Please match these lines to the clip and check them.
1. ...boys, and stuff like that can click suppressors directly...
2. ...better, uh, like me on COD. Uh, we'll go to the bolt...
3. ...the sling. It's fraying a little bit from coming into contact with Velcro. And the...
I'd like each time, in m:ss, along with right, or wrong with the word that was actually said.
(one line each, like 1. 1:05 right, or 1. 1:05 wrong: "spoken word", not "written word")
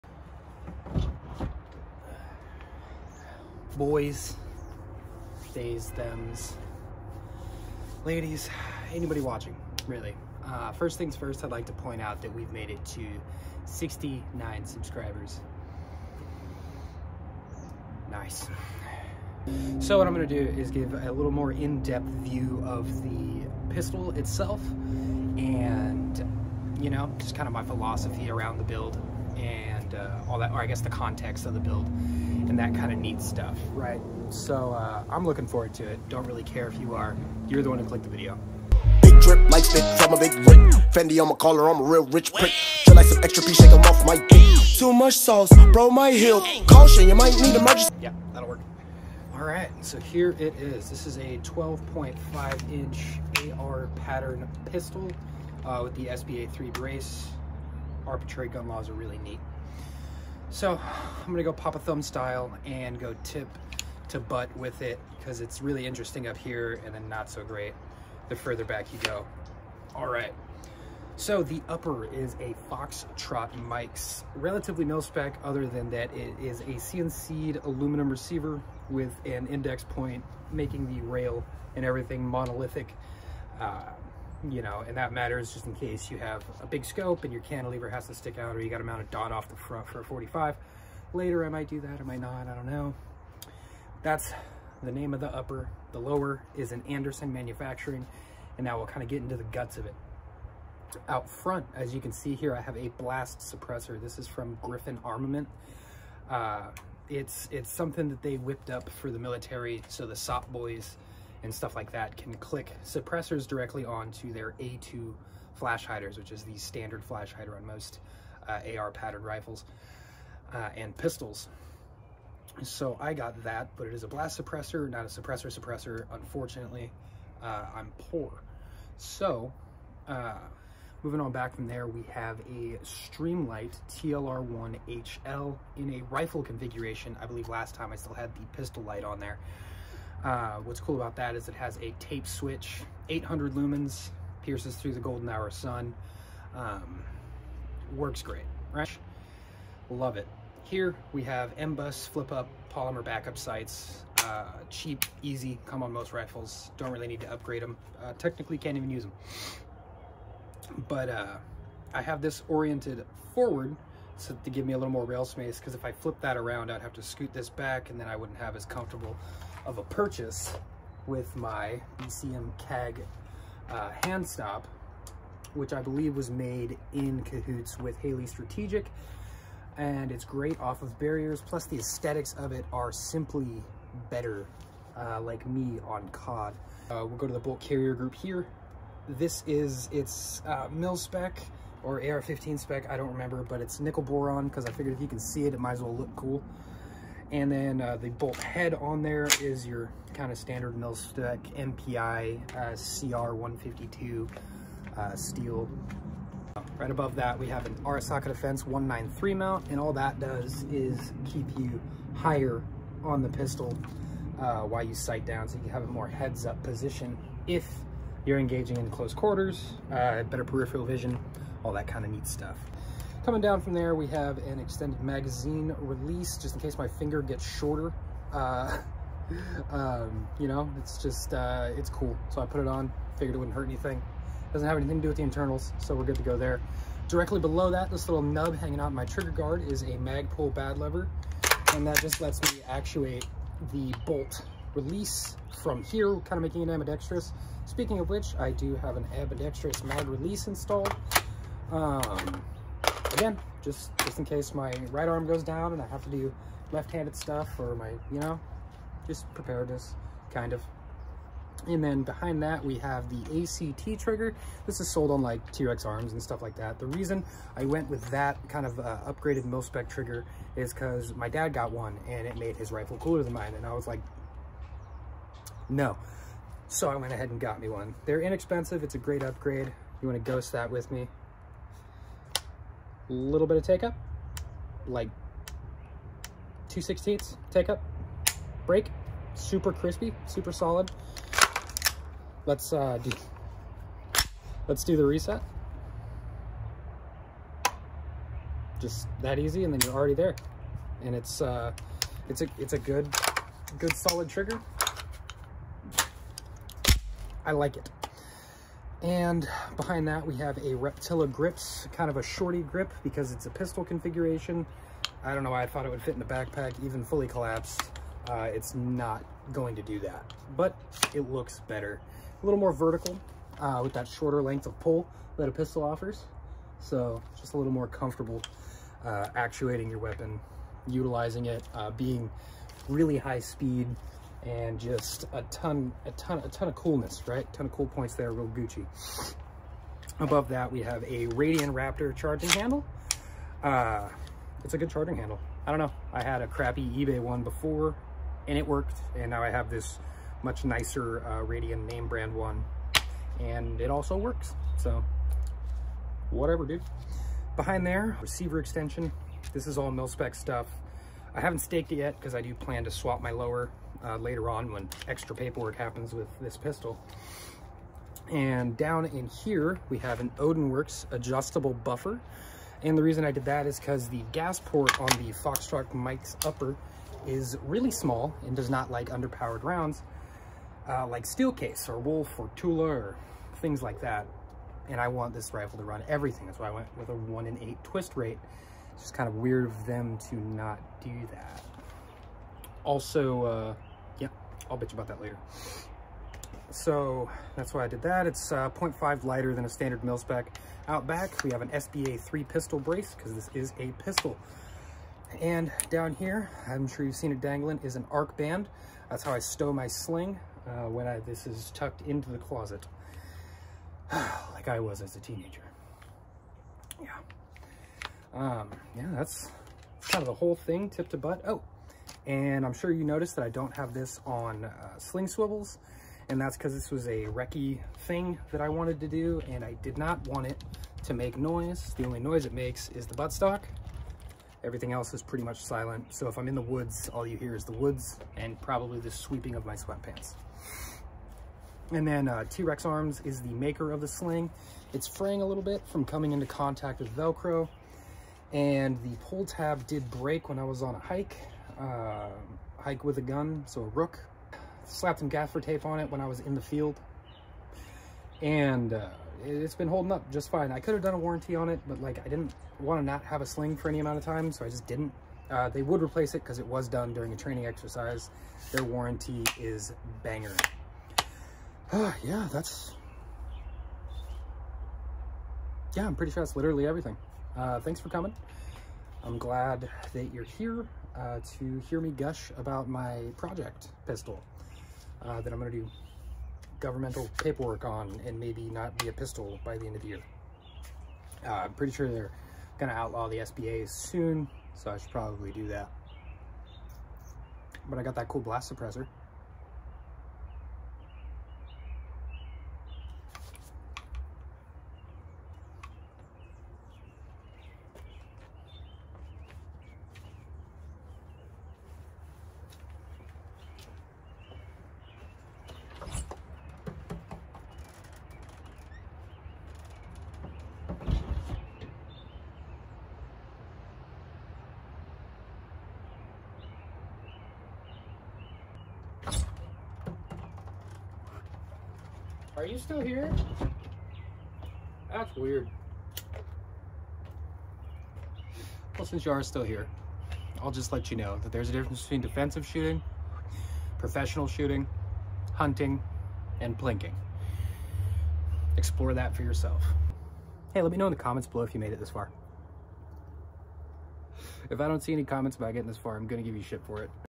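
1. 1:50 right
2. 3:04 right
3. 7:23 right.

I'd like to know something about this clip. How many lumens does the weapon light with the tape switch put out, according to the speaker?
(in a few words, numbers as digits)
800.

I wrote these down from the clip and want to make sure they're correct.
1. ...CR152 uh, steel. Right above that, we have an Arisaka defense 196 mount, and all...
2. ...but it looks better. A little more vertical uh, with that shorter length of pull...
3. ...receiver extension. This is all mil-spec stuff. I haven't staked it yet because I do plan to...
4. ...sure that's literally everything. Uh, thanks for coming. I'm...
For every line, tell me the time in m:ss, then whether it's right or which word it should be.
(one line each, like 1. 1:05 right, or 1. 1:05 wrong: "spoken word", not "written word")
1. 3:22 wrong: "193", not "196"
2. 5:20 right
3. 5:58 right
4. 7:56 right.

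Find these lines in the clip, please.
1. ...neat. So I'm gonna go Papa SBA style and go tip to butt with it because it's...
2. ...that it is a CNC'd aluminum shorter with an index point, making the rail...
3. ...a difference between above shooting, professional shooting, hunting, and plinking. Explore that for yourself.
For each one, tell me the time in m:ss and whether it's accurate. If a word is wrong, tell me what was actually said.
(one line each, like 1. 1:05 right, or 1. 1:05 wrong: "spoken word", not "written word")
1. 0:59 wrong: "Thumb", not "SBA"
2. 1:15 wrong: "receiver", not "shorter"
3. 9:01 wrong: "defensive", not "above".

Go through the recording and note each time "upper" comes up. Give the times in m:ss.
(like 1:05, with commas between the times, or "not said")
1:11, 1:35, 6:16.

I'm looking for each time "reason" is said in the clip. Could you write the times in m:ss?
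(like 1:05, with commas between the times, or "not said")
4:26, 6:13.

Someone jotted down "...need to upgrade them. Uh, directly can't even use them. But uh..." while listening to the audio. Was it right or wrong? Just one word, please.
wrong.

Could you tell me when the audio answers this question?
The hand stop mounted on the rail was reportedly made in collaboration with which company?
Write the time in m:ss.
2:57.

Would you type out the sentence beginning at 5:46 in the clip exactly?
I had a crappy eBay one before, and it worked.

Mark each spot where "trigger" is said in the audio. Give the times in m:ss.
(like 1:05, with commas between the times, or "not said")
3:59, 4:24, 4:29, 5:04.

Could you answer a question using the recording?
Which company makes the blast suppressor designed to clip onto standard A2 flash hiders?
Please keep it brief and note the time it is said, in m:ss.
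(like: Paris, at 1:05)
Griffin Armament, at 1:44.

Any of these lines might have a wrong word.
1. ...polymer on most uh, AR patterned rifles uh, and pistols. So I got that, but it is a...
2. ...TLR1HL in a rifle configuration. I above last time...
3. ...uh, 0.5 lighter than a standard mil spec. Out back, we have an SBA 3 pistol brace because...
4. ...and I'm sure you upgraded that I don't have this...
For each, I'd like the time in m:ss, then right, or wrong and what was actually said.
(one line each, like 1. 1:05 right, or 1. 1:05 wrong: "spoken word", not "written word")
1. 1:57 wrong: "hider", not "polymer"
2. 2:13 wrong: "believe", not "above"
3. 6:38 right
4. 7:02 wrong: "noticed", not "upgraded".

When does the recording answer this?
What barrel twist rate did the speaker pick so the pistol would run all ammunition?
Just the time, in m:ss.
6:27.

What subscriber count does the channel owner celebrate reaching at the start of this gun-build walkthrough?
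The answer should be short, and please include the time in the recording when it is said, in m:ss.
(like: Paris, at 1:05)
69, at 0:13.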